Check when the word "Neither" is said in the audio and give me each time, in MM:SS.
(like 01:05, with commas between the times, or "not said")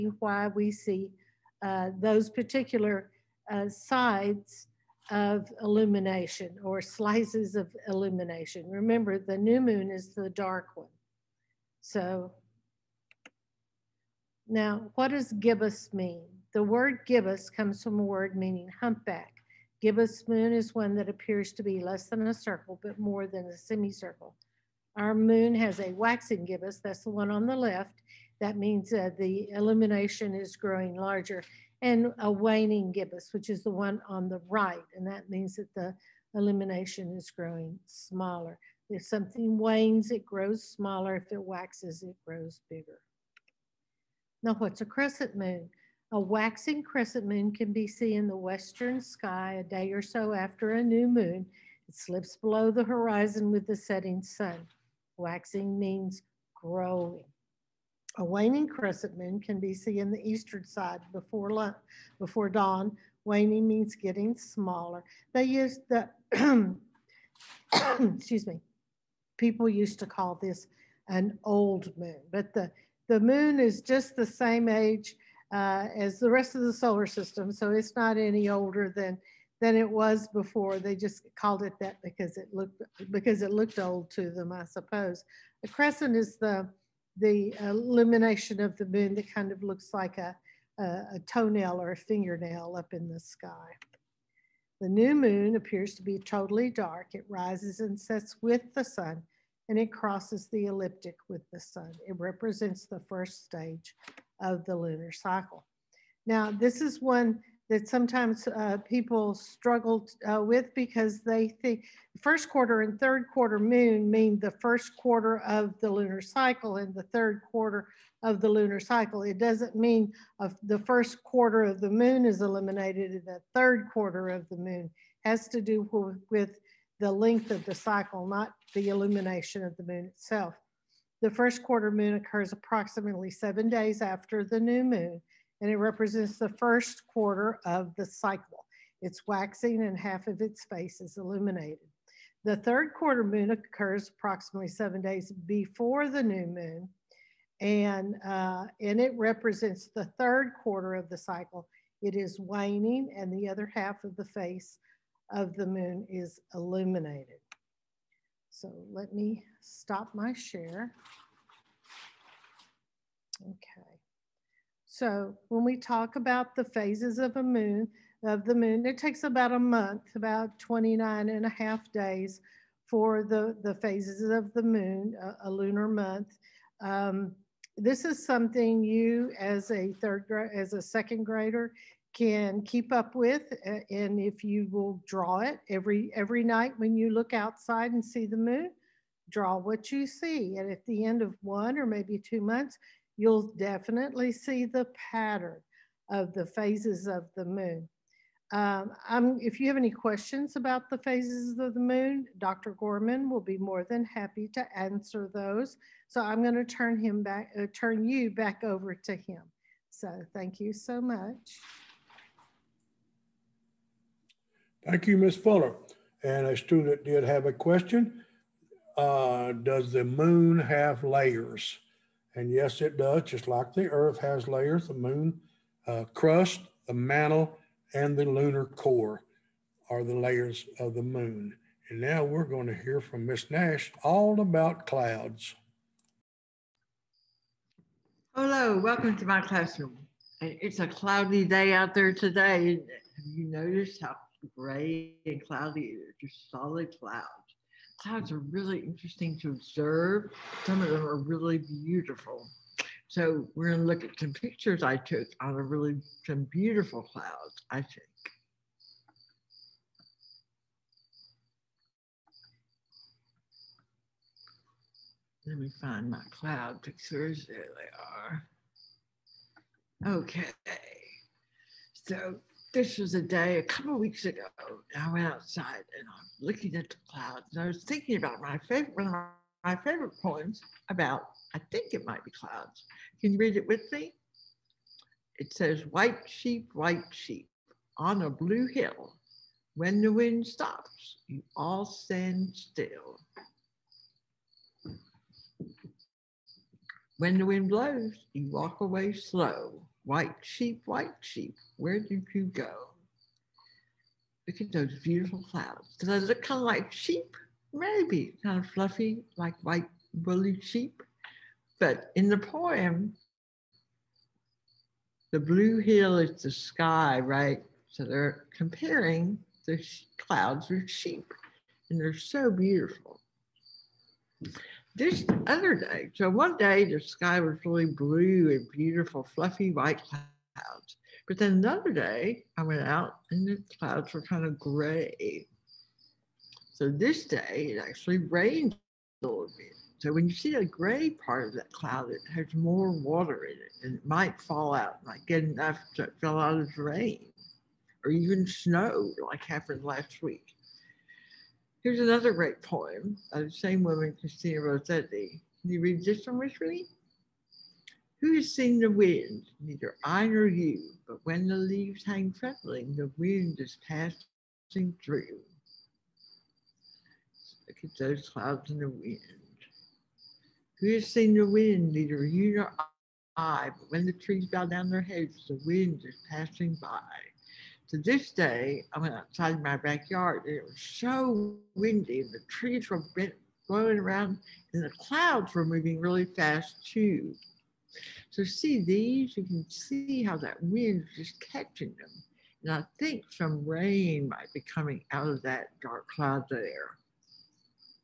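05:59, 06:11.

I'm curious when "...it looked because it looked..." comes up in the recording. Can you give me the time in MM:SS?
01:22.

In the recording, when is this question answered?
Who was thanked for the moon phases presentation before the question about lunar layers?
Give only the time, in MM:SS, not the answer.
03:35.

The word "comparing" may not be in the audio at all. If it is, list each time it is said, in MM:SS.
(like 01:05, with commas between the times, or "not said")
05:18.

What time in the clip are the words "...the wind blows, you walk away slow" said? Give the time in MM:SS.
04:57.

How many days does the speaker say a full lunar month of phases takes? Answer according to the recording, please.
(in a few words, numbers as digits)
29 and a half.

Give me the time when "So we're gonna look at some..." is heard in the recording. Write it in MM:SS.
04:13.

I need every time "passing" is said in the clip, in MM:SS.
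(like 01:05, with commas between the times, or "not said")
06:03, 06:16.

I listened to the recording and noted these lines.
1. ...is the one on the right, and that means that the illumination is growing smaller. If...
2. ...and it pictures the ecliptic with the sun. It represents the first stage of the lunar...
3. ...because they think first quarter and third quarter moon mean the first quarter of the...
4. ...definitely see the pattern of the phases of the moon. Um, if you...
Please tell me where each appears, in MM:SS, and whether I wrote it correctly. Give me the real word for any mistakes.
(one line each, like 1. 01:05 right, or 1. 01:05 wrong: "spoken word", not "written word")
1. 00:33 right
2. 01:39 wrong: "crosses", not "pictures"
3. 01:50 right
4. 03:13 right.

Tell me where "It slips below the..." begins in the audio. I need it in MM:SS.
00:51.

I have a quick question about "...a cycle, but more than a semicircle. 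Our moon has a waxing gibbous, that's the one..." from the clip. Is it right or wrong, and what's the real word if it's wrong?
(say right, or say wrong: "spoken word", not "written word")
wrong: "circle", not "cycle".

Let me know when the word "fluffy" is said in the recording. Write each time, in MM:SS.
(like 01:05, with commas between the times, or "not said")
05:08, 05:29.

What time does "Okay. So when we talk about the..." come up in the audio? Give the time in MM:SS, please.
02:43.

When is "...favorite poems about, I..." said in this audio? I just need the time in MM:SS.
04:39.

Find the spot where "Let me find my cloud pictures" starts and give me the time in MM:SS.
04:25.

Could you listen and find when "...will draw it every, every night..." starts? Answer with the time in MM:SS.
03:04.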